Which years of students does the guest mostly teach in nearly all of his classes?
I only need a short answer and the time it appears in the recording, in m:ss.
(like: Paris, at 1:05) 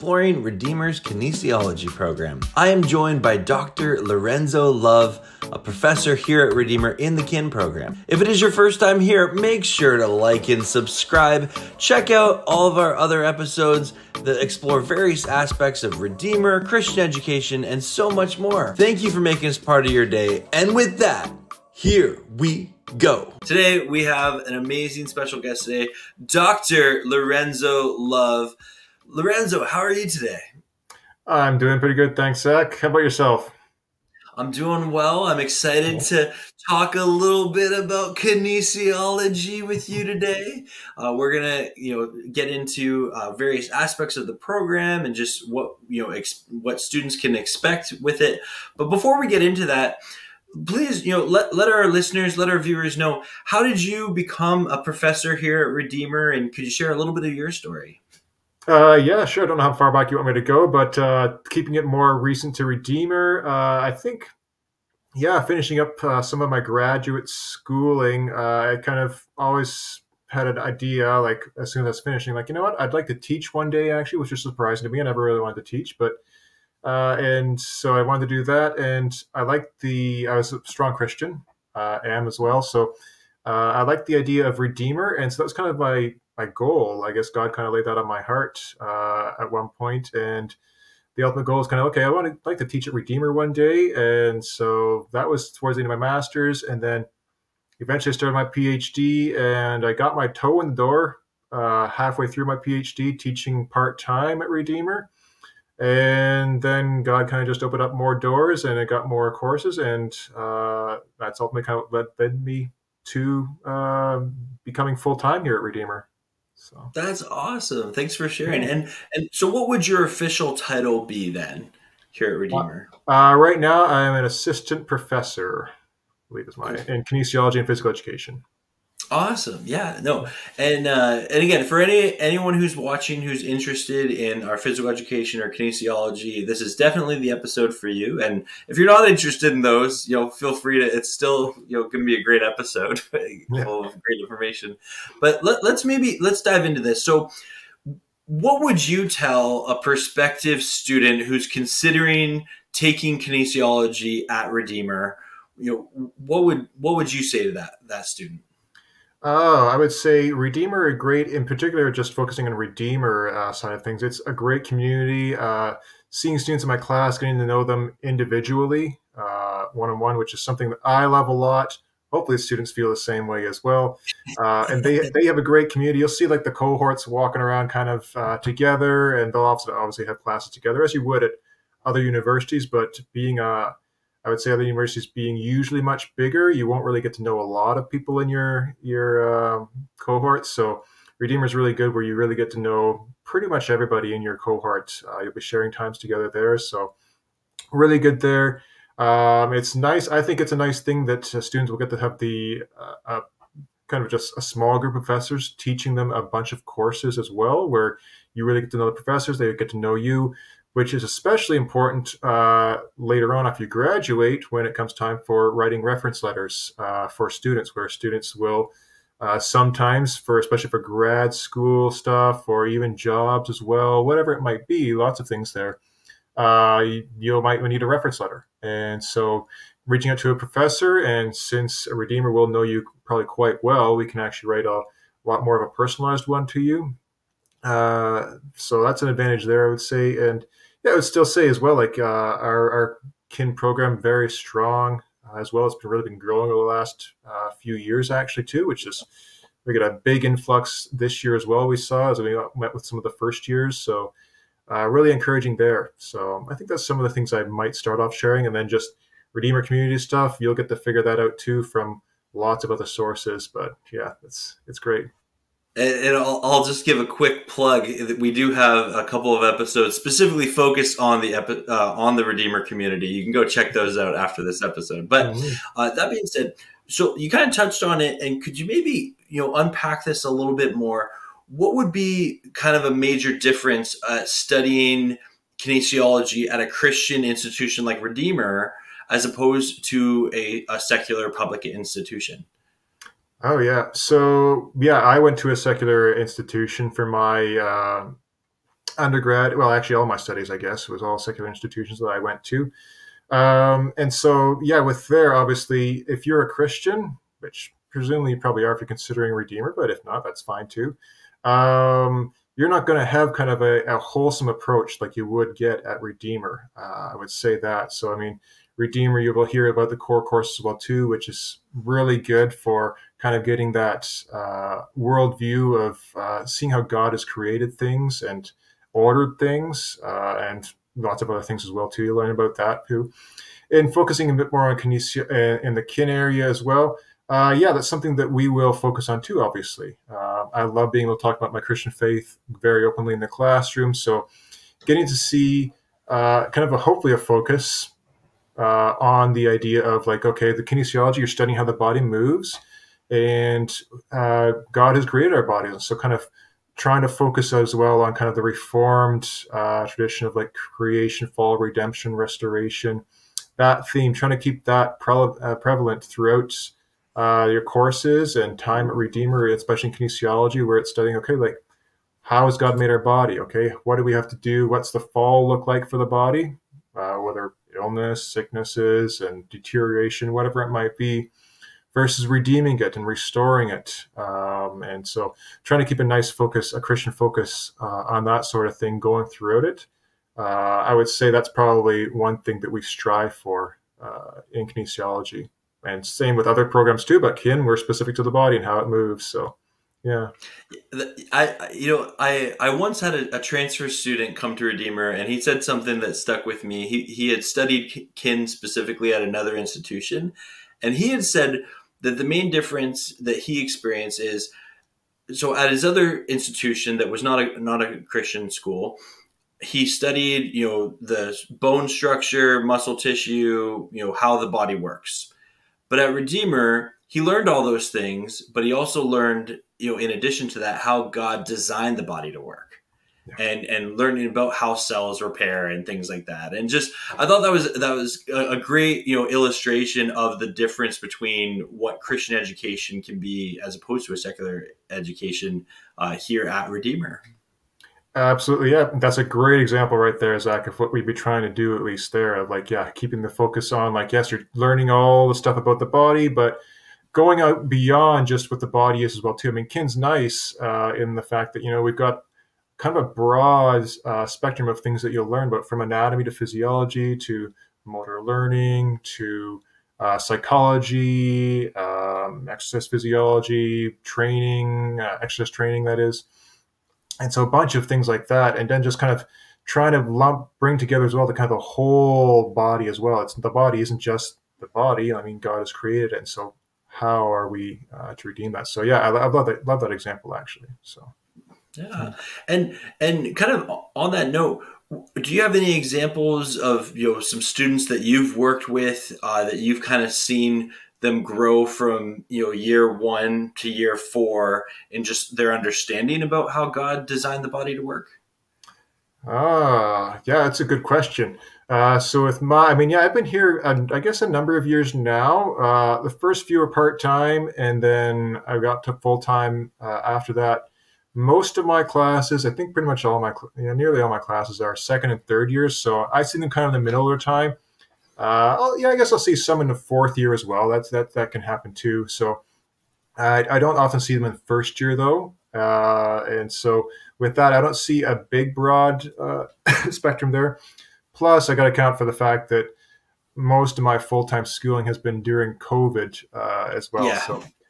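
Second and third years, at 8:44.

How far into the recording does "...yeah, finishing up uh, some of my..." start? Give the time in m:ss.
1:05.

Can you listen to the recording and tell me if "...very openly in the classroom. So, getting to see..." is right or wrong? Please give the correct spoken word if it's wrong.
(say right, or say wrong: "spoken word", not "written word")
right.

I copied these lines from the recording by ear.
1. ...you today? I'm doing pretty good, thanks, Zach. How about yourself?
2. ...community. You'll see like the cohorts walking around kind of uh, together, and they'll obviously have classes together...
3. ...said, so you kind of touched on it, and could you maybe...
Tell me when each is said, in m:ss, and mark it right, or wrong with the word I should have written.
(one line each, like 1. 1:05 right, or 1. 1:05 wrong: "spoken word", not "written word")
1. 0:29 right
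2. 2:55 right
3. 4:36 right.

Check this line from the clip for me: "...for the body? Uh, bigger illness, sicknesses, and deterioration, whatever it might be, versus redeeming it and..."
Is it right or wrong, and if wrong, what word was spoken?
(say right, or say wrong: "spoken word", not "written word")
wrong: "whether", not "bigger".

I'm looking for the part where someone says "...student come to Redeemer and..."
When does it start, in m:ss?
6:43.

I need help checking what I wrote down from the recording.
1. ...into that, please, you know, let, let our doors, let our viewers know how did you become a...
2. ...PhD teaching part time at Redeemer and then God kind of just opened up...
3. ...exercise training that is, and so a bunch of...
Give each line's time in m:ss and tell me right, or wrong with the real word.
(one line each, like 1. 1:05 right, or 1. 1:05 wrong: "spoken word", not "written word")
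1. 0:49 wrong: "listeners", not "doors"
2. 1:42 right
3. 7:55 right.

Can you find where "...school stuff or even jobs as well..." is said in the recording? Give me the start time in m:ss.
3:41.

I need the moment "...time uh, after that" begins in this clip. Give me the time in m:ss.
8:39.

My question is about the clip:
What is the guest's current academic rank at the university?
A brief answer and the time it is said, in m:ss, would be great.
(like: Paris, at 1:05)
Assistant professor, at 2:04.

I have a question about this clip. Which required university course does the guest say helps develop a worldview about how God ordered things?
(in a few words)
Core course.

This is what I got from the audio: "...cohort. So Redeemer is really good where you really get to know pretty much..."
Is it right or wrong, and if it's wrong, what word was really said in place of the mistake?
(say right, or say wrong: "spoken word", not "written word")
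right.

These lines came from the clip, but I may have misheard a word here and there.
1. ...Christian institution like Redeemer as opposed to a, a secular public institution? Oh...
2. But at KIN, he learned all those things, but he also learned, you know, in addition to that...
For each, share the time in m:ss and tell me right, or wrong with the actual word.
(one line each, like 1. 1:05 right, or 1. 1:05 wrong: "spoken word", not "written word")
1. 4:46 right
2. 7:05 wrong: "Redeemer", not "KIN".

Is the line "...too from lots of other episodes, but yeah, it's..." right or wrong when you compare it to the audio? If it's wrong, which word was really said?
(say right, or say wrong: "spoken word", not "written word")
wrong: "sources", not "episodes".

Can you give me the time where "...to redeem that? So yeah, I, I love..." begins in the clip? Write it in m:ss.
8:08.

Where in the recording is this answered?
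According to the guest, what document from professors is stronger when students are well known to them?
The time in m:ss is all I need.
3:35.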